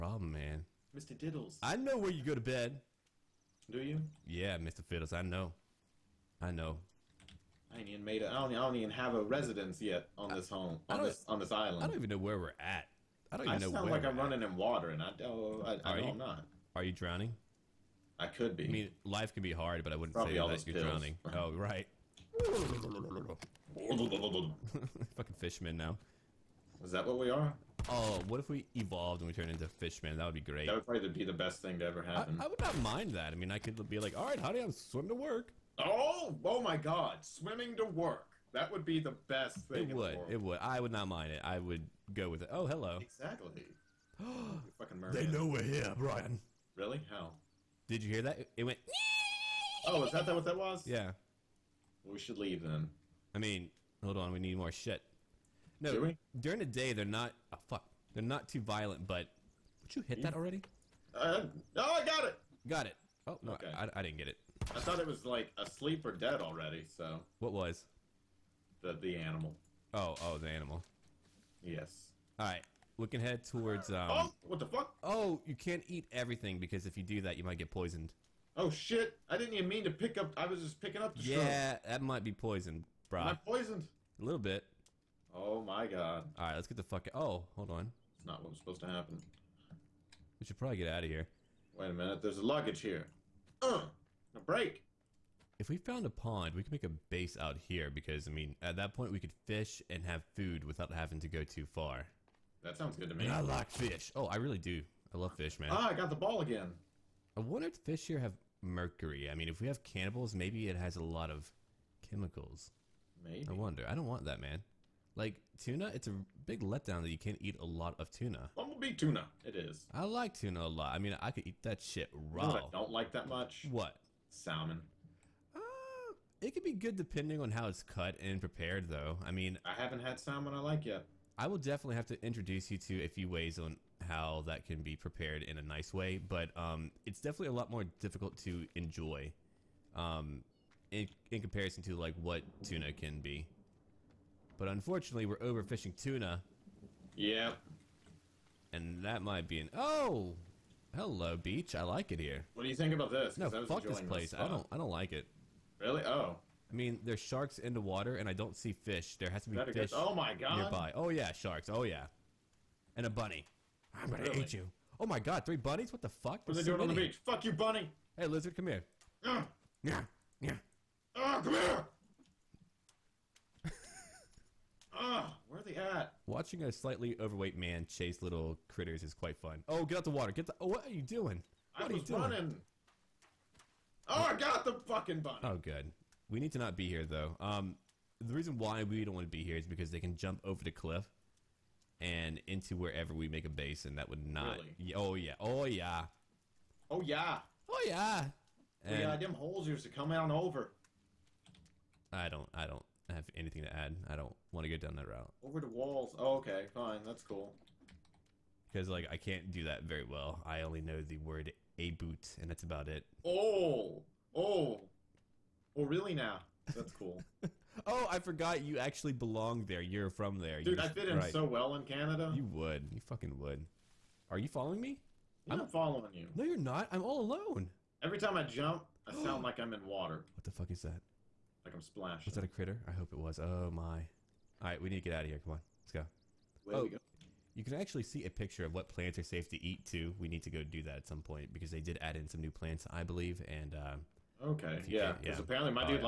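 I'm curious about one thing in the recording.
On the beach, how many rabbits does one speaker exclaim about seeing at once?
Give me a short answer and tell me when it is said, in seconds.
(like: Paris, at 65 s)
3, at 165 s.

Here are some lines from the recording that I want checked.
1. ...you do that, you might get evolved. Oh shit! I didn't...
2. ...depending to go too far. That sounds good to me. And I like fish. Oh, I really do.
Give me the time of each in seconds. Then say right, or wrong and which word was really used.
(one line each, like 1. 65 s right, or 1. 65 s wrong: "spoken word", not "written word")
1. 76 s wrong: "poisoned", not "evolved"
2. 100 s wrong: "having", not "depending".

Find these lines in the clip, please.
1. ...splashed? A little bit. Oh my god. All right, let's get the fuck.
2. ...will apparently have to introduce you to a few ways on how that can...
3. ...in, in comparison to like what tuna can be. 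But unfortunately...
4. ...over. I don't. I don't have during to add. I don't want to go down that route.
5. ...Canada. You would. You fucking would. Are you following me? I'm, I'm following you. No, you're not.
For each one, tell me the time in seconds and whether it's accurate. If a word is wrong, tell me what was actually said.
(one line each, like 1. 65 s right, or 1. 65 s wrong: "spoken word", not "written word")
1. 83 s wrong: "poisoned", not "splashed"
2. 131 s wrong: "definitely", not "apparently"
3. 140 s right
4. 200 s wrong: "anything", not "during"
5. 221 s right.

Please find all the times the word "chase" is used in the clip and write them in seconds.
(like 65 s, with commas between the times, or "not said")
177 s.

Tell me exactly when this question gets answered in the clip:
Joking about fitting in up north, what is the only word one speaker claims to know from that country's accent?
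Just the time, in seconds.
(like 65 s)
211 s.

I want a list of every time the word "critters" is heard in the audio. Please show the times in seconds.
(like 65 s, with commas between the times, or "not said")
178 s, 232 s.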